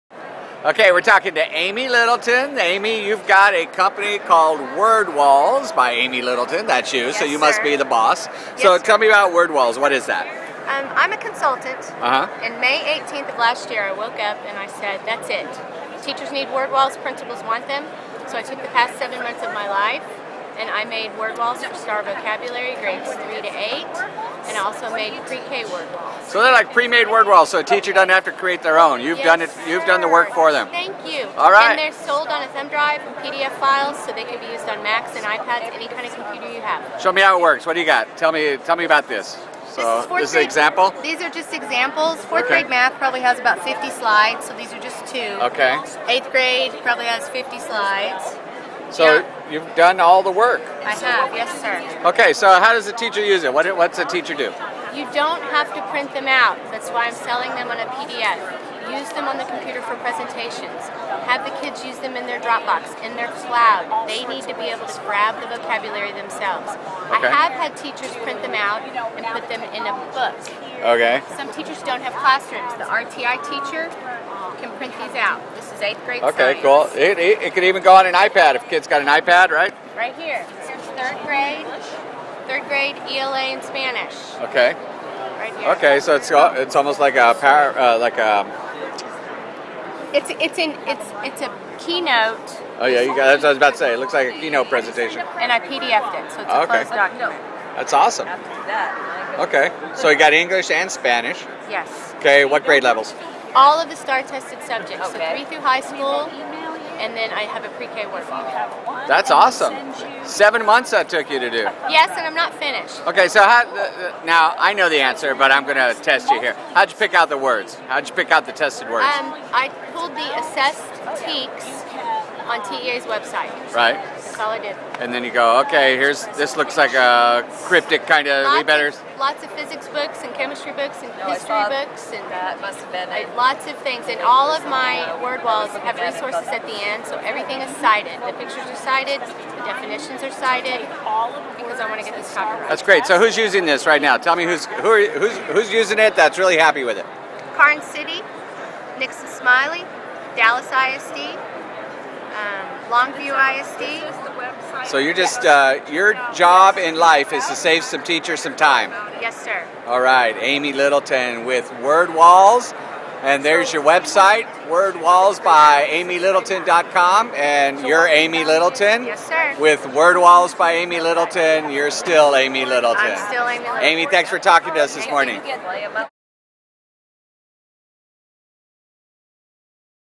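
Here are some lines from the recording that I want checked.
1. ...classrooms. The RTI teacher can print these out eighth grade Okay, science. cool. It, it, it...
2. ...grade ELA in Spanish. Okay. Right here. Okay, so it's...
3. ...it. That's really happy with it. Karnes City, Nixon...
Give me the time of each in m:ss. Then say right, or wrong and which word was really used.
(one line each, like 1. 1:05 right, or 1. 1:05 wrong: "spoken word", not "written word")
1. 1:12 right
2. 1:22 right
3. 2:25 right.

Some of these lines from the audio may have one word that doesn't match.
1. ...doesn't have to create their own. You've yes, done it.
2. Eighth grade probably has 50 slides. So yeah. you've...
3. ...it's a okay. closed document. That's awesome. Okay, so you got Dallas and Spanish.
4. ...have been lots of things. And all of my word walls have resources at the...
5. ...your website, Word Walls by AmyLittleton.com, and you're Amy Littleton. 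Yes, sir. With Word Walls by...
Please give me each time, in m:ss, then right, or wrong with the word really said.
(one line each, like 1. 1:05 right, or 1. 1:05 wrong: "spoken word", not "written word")
1. 0:27 right
2. 0:46 right
3. 1:36 wrong: "English", not "Dallas"
4. 2:12 right
5. 2:43 right.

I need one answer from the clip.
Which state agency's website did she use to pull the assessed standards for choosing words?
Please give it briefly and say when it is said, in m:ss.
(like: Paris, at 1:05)
TEA, at 2:02.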